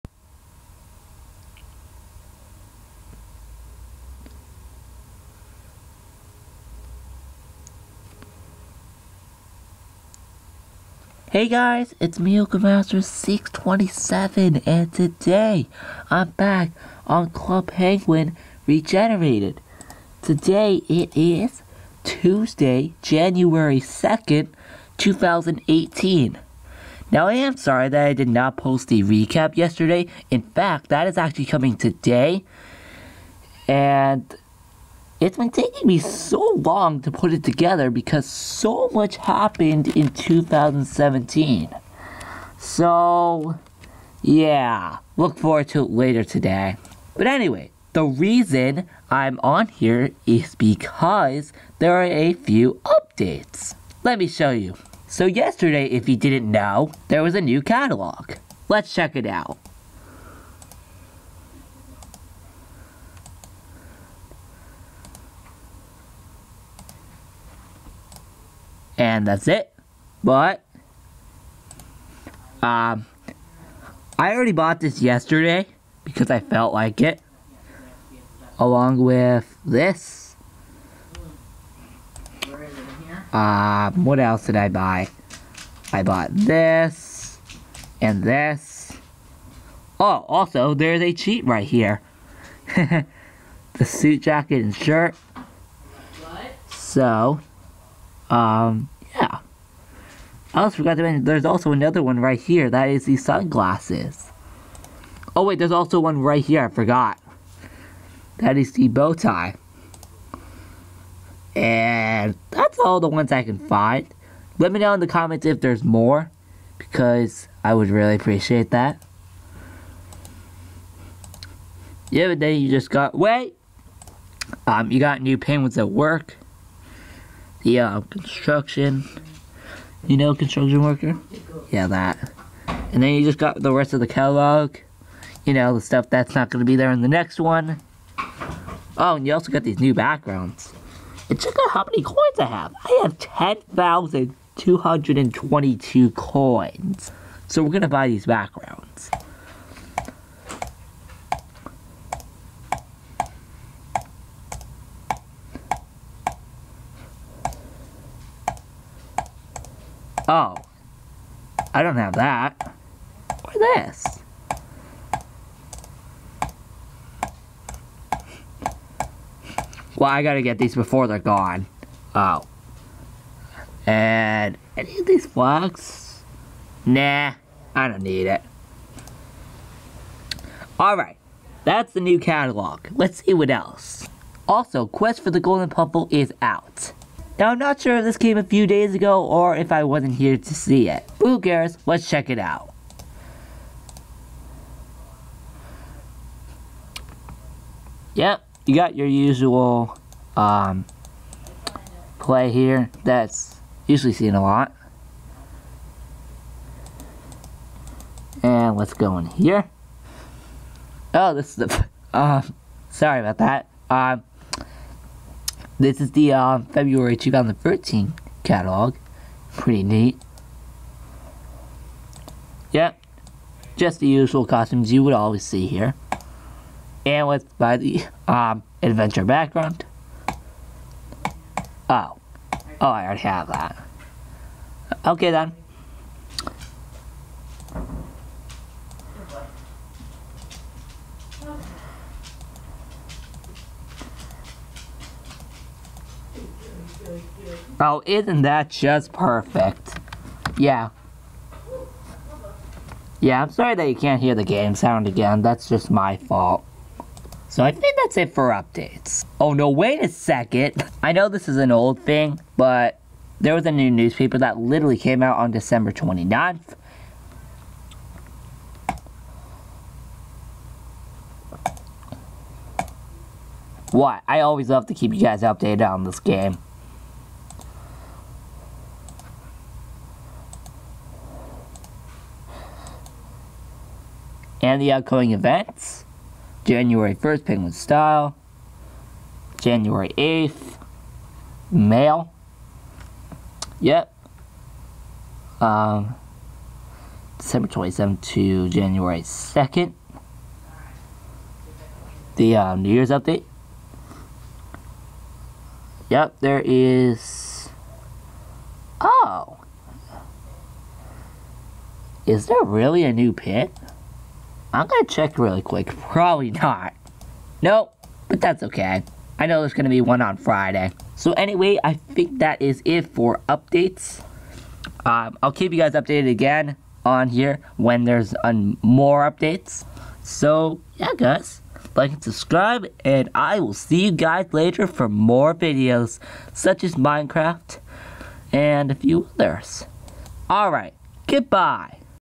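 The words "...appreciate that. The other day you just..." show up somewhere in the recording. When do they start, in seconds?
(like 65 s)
118 s.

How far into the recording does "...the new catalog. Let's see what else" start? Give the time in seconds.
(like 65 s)
181 s.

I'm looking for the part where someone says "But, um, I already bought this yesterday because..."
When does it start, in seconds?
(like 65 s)
70 s.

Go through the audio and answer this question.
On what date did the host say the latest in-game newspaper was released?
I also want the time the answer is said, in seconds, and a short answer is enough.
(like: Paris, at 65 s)
December 29th, at 265 s.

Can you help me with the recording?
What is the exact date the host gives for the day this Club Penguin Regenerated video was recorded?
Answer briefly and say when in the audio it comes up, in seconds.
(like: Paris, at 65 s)
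January 2nd, 2018, at 23 s.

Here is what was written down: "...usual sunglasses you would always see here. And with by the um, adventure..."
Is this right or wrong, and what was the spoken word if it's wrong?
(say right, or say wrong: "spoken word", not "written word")
wrong: "costumes", not "sunglasses".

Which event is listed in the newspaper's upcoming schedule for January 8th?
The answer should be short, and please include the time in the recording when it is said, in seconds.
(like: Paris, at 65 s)
Mail, at 291 s.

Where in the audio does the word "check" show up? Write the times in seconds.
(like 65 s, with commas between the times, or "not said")
58 s, 141 s, 192 s, 315 s.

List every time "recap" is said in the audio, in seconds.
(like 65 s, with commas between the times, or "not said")
29 s.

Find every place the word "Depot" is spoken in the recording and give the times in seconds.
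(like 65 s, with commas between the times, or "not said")
not said.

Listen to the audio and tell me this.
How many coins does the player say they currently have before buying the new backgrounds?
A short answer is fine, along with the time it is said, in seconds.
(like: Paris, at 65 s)
10,222, at 143 s.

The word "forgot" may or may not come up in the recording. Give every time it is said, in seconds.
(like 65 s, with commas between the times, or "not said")
100 s, 106 s.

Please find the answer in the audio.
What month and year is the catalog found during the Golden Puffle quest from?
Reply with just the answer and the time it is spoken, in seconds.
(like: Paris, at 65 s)
February 2013, at 216 s.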